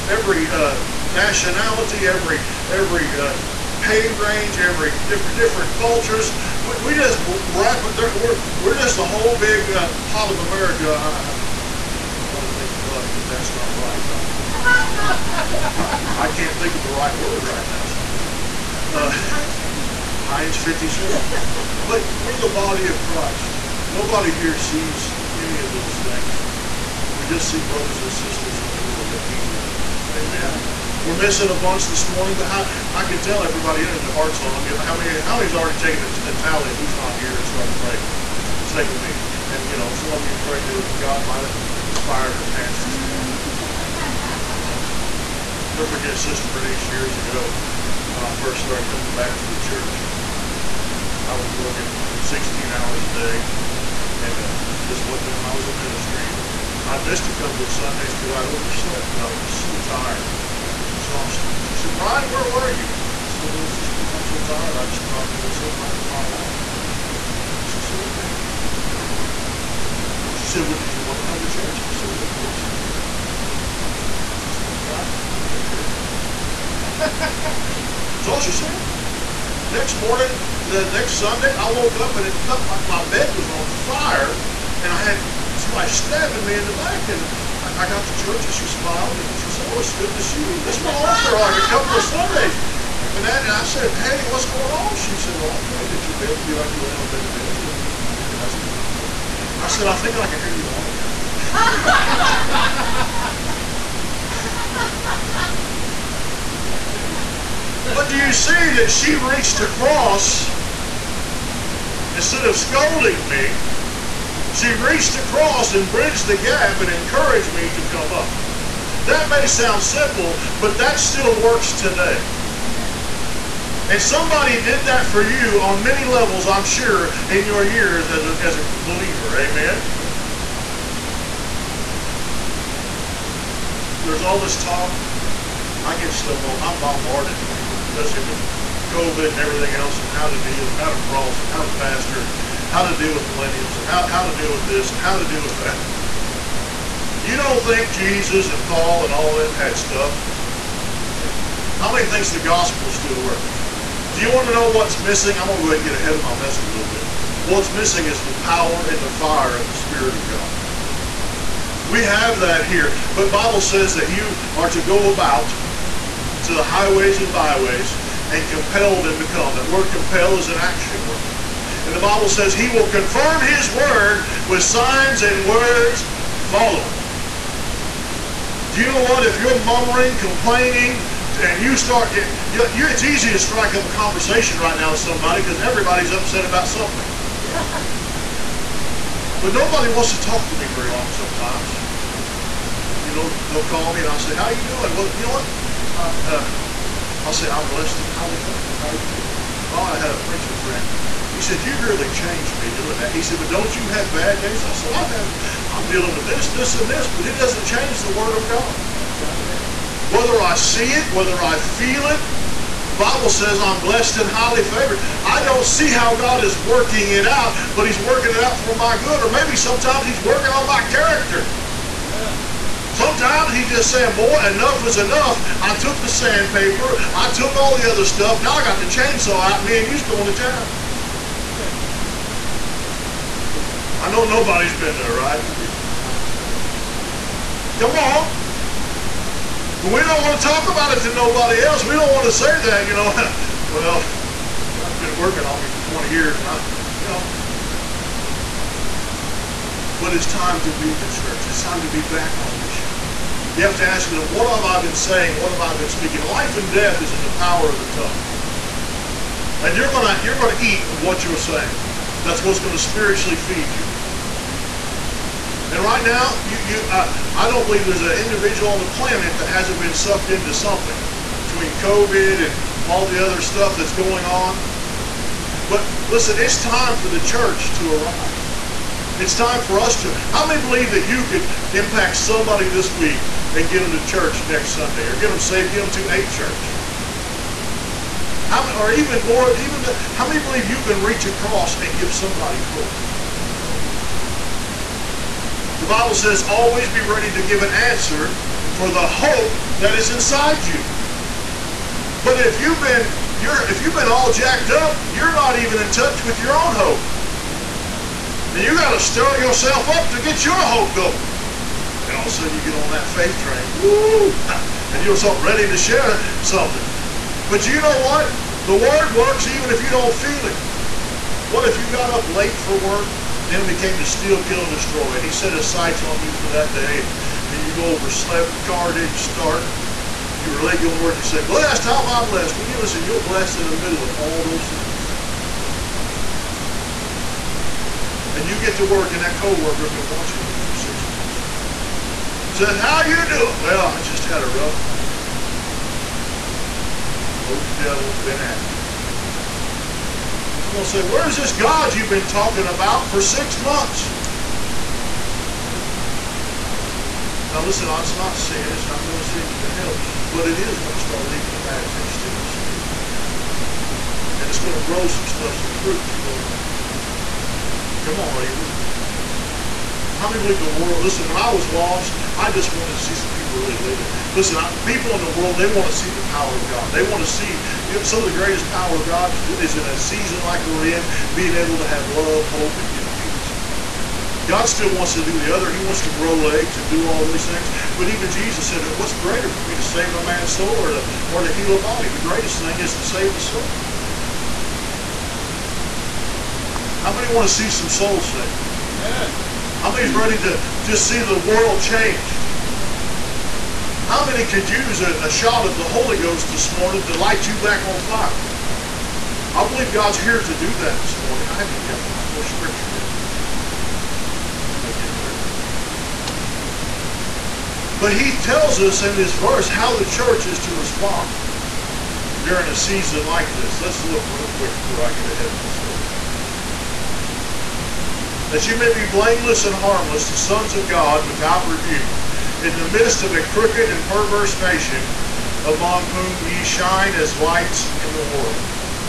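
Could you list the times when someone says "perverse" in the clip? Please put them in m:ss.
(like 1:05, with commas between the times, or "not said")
7:14.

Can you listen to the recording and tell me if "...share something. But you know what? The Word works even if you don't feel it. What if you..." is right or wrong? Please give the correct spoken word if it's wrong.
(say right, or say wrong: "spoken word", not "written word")
right.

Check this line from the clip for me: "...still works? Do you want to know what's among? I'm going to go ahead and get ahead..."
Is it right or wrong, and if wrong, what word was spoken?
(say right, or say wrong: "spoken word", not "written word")
wrong: "missing", not "among".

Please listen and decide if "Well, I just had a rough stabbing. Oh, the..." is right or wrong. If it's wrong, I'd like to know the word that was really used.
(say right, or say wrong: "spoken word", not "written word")
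wrong: "morning", not "stabbing".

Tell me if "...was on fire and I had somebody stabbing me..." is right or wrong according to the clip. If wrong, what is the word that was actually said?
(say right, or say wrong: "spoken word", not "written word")
right.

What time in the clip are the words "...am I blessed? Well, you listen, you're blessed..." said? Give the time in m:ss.
5:32.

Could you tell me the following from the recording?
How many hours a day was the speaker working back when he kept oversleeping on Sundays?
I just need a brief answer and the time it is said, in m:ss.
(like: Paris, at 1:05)
16, at 0:52.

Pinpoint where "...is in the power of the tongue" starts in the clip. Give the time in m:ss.
4:17.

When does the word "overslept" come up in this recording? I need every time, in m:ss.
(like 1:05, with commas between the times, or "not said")
0:58, 5:27.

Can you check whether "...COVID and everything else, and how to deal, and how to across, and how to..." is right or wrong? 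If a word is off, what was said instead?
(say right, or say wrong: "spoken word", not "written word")
wrong: "cross", not "across".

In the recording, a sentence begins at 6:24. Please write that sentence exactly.
God still wants to do the other.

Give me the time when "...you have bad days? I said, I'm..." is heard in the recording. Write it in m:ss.
3:23.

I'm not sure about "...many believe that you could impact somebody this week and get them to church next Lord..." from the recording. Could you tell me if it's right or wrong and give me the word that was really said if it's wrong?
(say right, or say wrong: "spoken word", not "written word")
wrong: "Sunday", not "Lord".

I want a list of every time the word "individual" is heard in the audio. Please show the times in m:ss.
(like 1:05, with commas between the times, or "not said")
4:28.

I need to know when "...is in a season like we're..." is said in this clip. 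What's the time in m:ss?
6:19.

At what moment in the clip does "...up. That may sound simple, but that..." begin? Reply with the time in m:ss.
1:58.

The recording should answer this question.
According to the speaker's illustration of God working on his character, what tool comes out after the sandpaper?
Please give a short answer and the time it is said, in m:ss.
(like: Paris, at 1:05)
chainsaw, at 3:48.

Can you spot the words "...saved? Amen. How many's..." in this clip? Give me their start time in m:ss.
6:38.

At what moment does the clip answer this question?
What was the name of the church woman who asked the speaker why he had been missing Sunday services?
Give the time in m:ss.
0:46.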